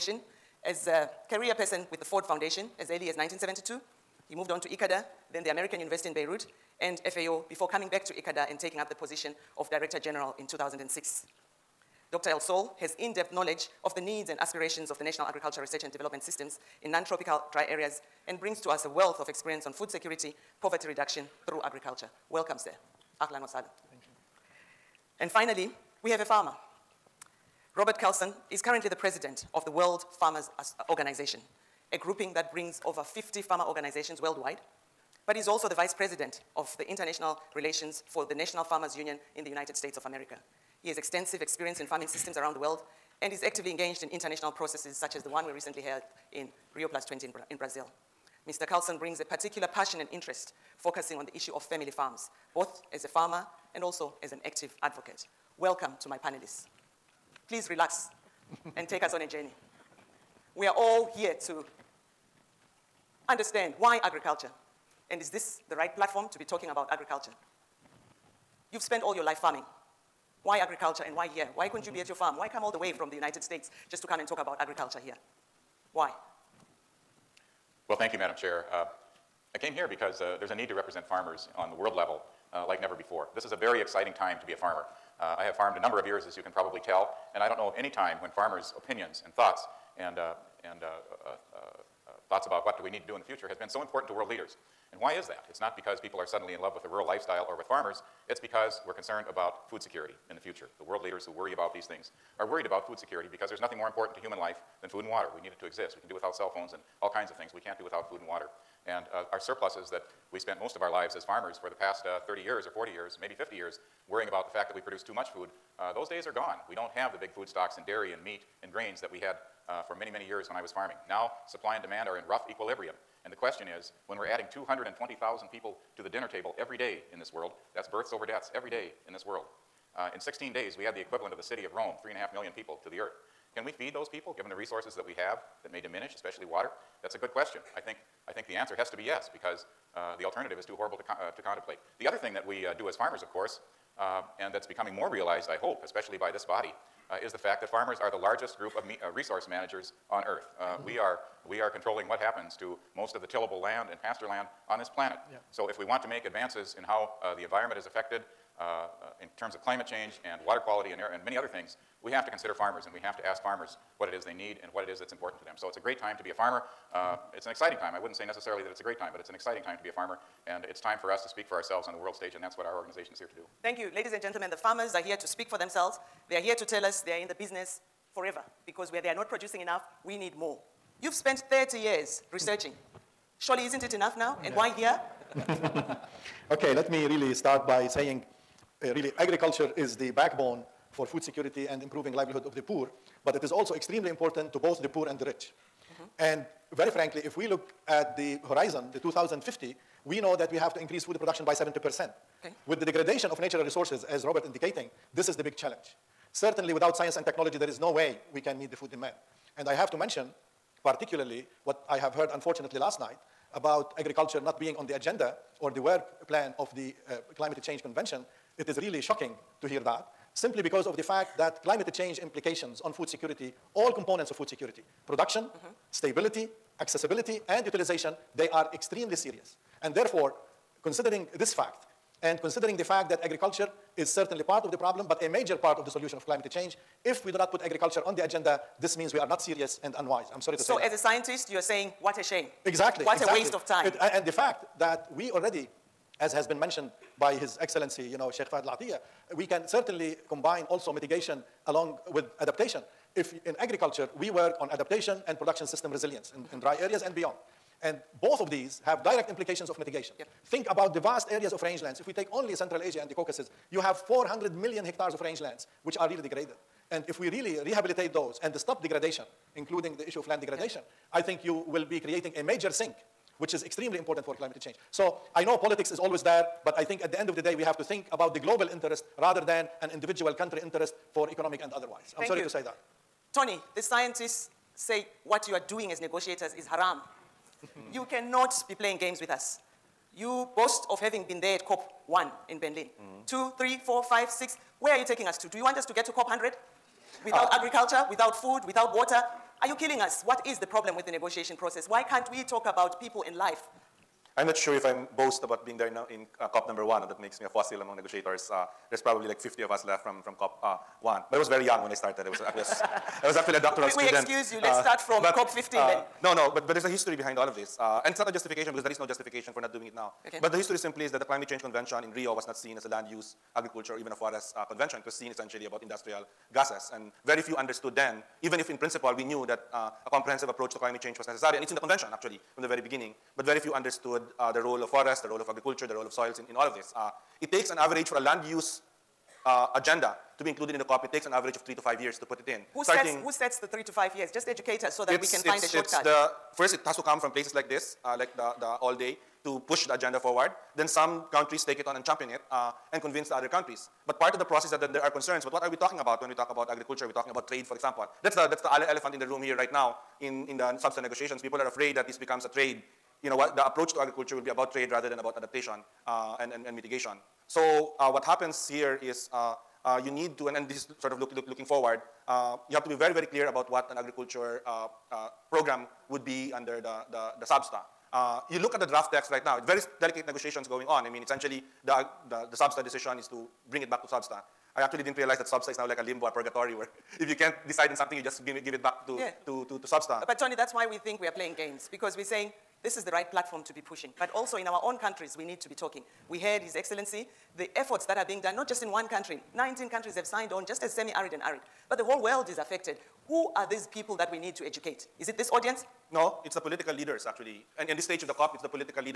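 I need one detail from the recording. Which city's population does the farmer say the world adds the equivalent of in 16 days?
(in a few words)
Rome.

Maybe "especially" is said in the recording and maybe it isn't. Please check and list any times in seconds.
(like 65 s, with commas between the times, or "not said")
136 s, 145 s.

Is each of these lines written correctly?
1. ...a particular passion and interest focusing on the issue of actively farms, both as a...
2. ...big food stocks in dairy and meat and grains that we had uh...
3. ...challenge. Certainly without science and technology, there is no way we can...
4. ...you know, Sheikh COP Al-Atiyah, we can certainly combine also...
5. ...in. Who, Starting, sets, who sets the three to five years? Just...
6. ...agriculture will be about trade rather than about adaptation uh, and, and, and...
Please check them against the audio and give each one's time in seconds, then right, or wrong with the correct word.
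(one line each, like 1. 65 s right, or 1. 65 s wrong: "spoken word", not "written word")
1. 49 s wrong: "family", not "actively"
2. 117 s right
3. 205 s right
4. 248 s wrong: "Fahd", not "COP"
5. 342 s right
6. 363 s right.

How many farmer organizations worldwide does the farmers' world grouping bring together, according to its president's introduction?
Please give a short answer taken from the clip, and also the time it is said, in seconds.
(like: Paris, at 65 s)
over 50, at 32 s.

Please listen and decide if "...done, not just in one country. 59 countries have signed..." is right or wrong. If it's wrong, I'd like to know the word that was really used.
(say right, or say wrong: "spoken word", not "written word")
wrong: "19", not "59".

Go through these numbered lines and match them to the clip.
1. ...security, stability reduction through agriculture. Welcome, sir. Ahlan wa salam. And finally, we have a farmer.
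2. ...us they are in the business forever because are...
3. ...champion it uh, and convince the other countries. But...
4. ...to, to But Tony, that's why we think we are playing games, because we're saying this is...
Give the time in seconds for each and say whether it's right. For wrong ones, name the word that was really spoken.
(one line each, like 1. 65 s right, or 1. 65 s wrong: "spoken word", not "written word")
1. 19 s wrong: "poverty", not "stability"
2. 176 s right
3. 352 s right
4. 389 s right.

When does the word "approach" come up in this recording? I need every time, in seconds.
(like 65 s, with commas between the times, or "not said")
330 s, 363 s.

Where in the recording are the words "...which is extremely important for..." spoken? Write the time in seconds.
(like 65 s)
273 s.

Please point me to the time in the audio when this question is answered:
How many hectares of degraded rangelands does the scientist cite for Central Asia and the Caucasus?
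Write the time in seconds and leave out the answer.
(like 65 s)
263 s.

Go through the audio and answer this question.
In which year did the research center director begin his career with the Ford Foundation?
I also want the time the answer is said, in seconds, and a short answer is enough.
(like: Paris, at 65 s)
1972, at 3 s.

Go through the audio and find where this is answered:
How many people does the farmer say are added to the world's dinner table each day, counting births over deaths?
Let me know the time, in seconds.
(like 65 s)
124 s.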